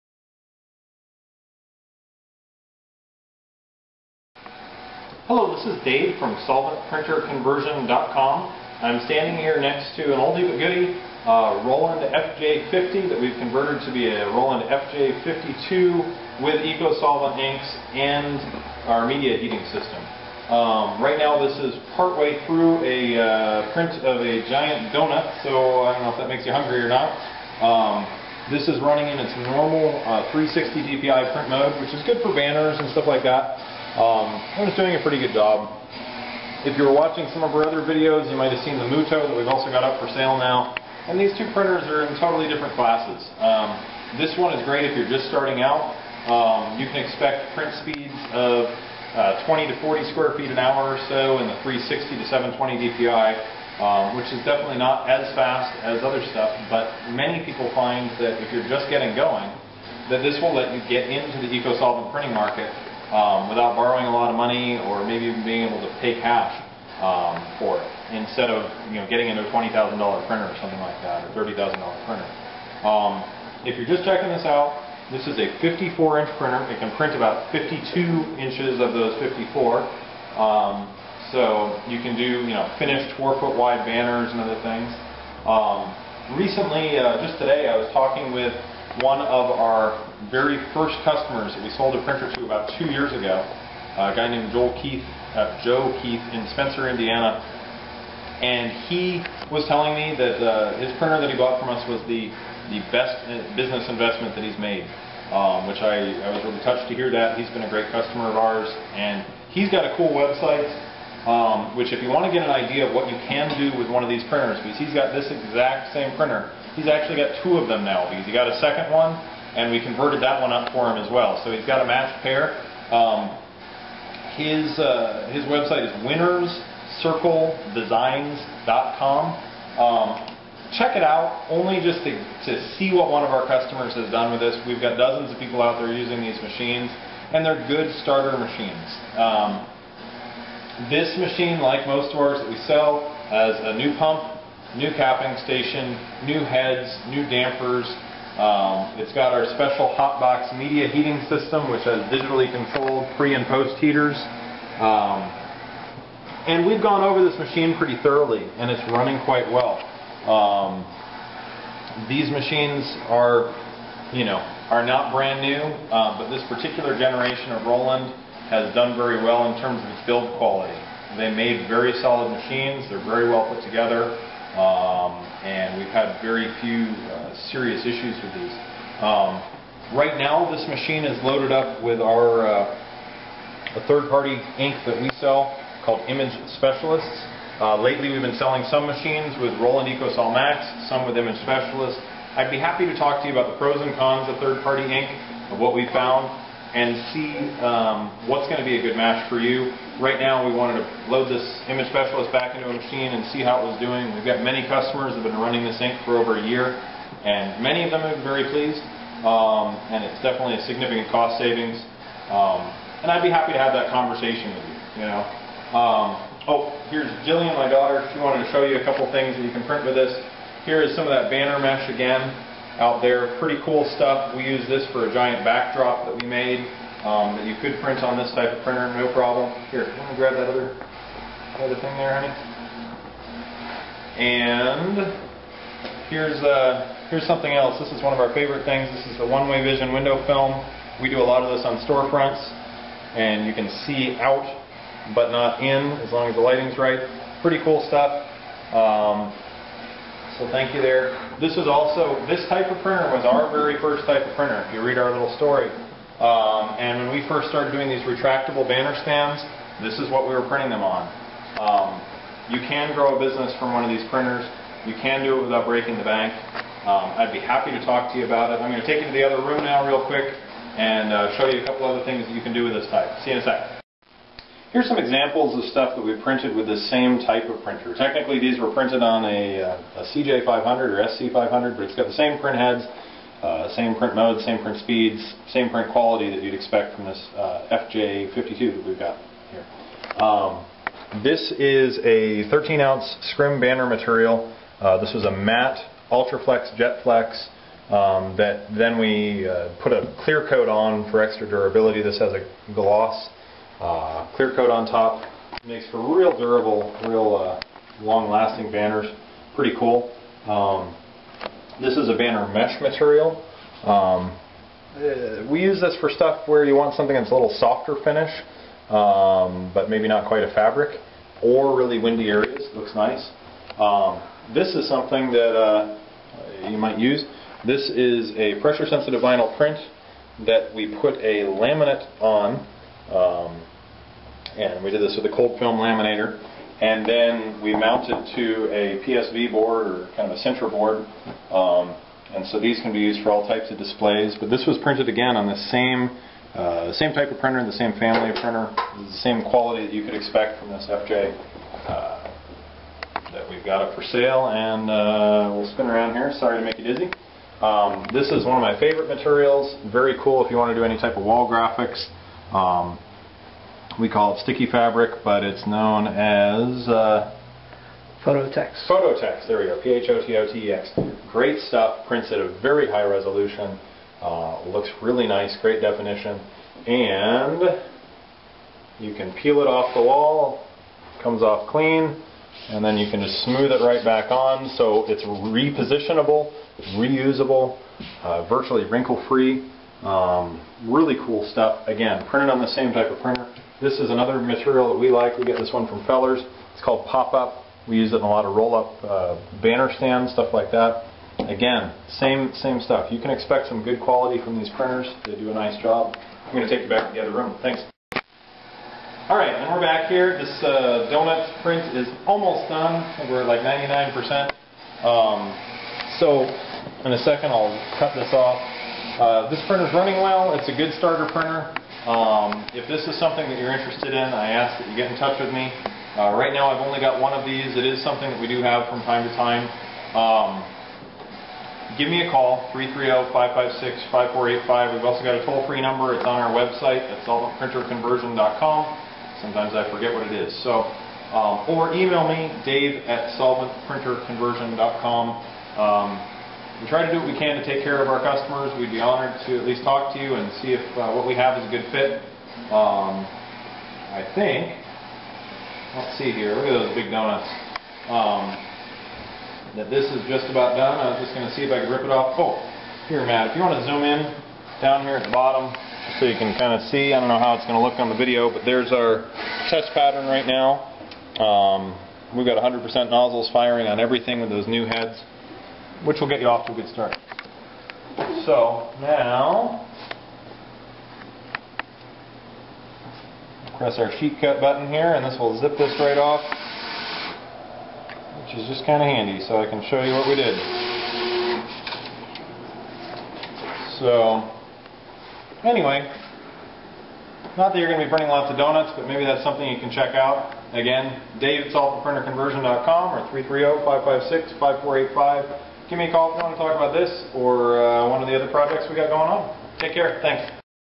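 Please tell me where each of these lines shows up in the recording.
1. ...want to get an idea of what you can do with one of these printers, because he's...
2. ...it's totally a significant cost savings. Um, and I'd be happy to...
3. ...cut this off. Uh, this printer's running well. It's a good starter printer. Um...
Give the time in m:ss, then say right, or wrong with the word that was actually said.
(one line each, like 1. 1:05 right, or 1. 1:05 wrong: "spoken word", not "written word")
1. 1:52 right
2. 3:30 wrong: "definitely", not "totally"
3. 6:57 right.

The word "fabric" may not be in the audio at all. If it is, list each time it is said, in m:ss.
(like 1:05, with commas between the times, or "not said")
5:20, 6:04.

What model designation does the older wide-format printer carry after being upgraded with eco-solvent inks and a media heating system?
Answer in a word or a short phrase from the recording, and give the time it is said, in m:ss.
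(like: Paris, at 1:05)
Roland FJ52, at 0:14.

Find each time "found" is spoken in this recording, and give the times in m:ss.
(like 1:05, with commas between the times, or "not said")
3:15.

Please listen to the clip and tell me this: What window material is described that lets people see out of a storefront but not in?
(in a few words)
one-way vision window film.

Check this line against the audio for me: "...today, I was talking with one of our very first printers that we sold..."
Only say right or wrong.
wrong.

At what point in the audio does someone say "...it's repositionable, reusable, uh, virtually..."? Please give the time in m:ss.
6:25.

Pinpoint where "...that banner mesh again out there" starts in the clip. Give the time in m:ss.
3:41.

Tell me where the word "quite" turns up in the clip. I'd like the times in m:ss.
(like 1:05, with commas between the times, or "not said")
2:39, 5:20.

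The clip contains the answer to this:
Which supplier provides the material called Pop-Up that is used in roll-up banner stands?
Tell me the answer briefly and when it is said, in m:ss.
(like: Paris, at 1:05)
Fellers, at 6:36.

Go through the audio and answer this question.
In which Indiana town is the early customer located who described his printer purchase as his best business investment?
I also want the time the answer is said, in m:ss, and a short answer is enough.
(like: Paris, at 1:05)
Spencer, at 1:36.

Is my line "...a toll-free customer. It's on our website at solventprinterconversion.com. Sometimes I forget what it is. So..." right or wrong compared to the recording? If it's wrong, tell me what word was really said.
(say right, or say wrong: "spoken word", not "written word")
wrong: "number", not "customer".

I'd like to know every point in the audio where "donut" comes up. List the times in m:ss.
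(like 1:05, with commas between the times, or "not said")
0:24, 6:51, 7:37, 8:18.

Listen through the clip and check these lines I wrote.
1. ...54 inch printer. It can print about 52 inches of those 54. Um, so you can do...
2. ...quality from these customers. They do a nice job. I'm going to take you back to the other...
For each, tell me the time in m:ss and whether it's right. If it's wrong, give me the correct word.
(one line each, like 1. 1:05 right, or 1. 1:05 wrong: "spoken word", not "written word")
1. 1:15 right
2. 6:43 wrong: "printers", not "customers".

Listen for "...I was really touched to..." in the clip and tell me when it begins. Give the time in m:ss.
1:46.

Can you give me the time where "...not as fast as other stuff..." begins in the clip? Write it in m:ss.
0:54.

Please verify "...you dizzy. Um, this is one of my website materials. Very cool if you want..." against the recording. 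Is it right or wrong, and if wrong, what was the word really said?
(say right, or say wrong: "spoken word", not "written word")
wrong: "favorite", not "website".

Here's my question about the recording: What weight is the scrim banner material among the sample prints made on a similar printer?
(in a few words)
13-ounce.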